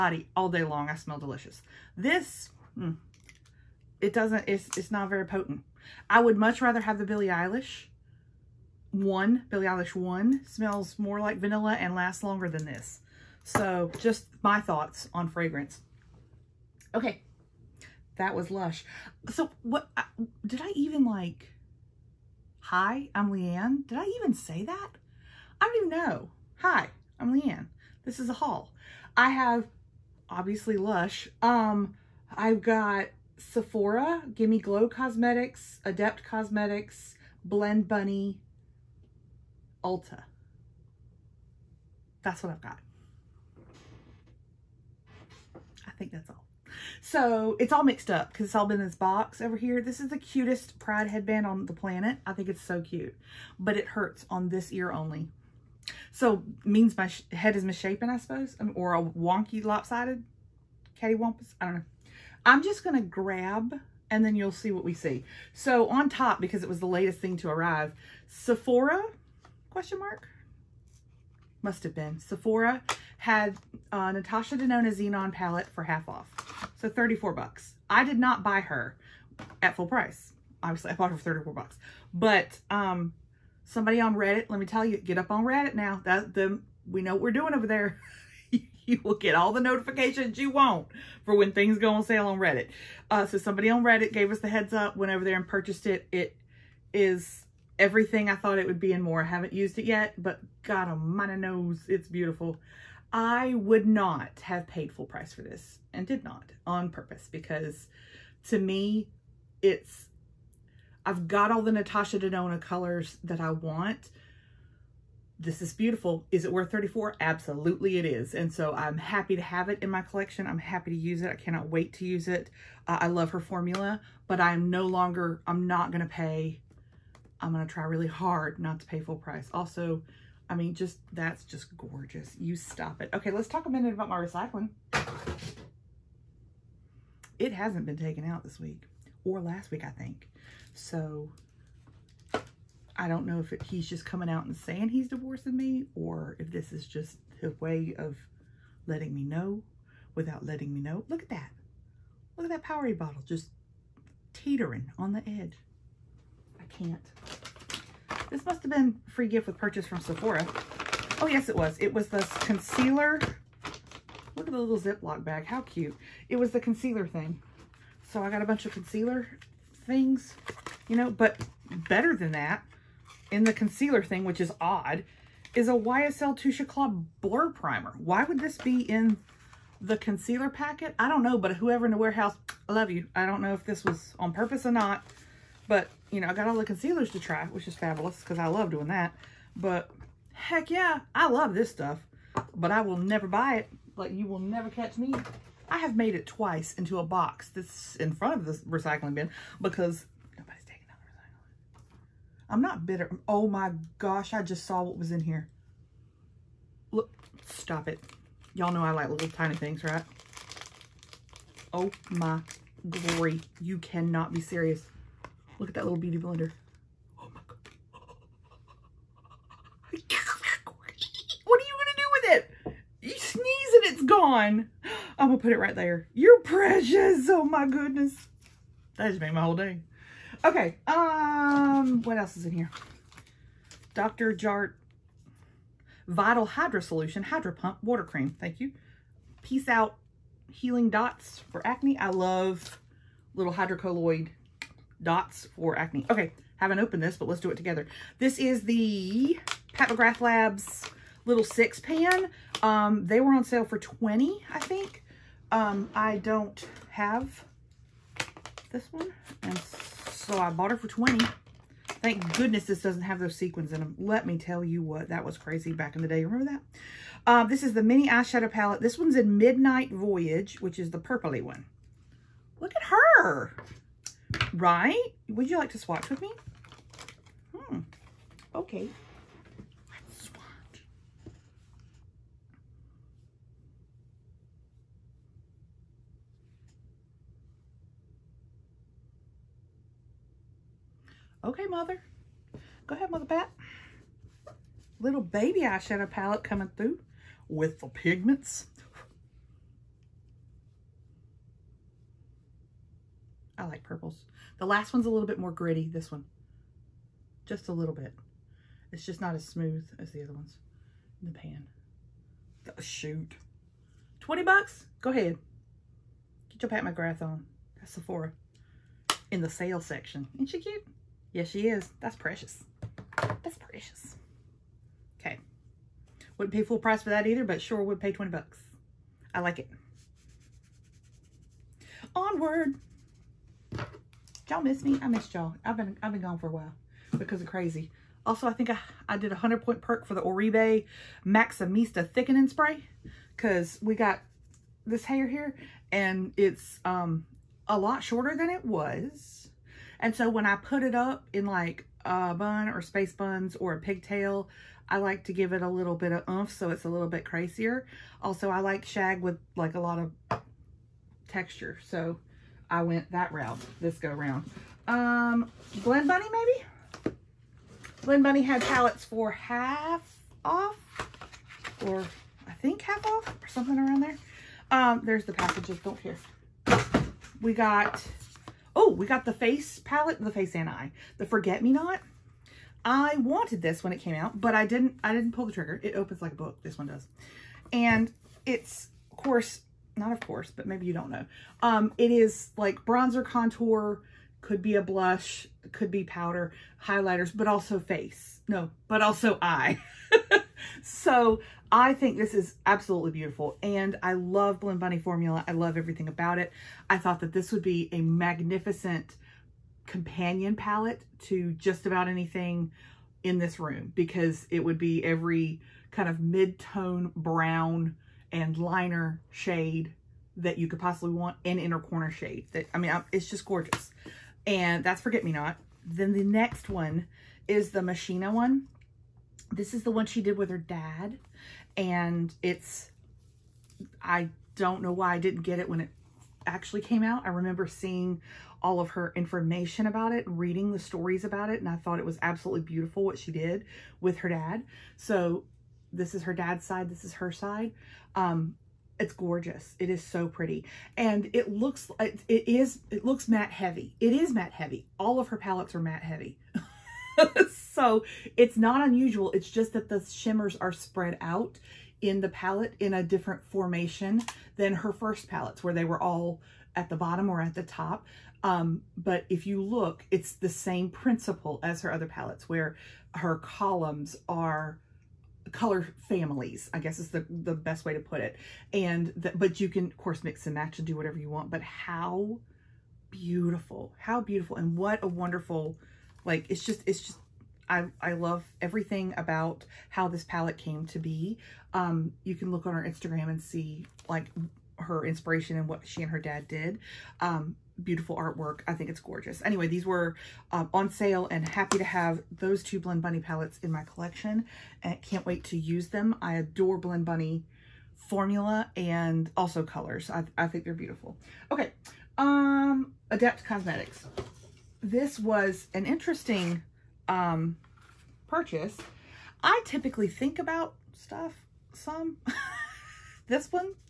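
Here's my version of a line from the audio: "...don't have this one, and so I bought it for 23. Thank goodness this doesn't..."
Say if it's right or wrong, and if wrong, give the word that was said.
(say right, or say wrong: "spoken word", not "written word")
wrong: "20", not "23".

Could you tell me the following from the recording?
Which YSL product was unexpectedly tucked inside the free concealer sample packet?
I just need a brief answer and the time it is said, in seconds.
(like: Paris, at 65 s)
Touche Éclat Blur Primer, at 176 s.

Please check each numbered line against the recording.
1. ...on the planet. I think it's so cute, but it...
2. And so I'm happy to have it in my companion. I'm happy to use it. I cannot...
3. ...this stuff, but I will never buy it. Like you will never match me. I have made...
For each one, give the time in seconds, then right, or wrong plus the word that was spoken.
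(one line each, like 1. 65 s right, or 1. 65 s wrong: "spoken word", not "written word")
1. 51 s right
2. 118 s wrong: "collection", not "companion"
3. 191 s wrong: "catch", not "match".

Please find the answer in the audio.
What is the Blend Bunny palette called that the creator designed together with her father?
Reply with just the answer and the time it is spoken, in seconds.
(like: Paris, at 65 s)
Machina, at 427 s.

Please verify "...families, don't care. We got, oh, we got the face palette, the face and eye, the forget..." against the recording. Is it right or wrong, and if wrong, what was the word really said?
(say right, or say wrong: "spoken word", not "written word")
wrong: "packages", not "families".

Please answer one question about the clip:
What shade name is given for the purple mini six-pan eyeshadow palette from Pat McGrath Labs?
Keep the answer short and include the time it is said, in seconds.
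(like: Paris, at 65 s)
Midnight Voyage, at 269 s.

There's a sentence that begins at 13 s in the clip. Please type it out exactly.
So just my thoughts on fragrance.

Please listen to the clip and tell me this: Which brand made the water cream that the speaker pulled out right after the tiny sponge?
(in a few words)
Dr. Jart.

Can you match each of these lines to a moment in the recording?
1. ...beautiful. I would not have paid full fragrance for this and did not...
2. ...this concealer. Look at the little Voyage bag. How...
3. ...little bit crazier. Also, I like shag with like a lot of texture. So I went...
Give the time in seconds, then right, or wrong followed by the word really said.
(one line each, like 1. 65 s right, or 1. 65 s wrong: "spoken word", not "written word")
1. 102 s wrong: "price", not "fragrance"
2. 162 s wrong: "Ziploc", not "Voyage"
3. 356 s right.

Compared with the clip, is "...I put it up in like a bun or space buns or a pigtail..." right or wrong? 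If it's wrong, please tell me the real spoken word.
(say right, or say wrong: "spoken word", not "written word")
right.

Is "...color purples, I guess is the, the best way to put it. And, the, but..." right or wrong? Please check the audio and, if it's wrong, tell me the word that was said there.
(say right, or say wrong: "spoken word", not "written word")
wrong: "families", not "purples".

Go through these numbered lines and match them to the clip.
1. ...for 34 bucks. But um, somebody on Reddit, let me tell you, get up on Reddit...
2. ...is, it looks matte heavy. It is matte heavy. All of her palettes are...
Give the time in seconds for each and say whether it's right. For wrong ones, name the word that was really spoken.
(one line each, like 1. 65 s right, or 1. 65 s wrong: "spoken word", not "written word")
1. 81 s right
2. 452 s right.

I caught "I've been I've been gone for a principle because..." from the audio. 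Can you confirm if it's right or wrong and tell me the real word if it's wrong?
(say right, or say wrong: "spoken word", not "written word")
wrong: "while", not "principle".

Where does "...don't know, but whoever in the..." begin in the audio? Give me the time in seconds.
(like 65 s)
181 s.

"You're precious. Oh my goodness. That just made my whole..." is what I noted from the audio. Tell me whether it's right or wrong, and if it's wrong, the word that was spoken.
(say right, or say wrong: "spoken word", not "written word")
right.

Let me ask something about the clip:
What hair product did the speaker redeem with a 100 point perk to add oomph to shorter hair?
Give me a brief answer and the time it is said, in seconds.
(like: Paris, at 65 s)
Oribe Maximista Thickening Spray, at 340 s.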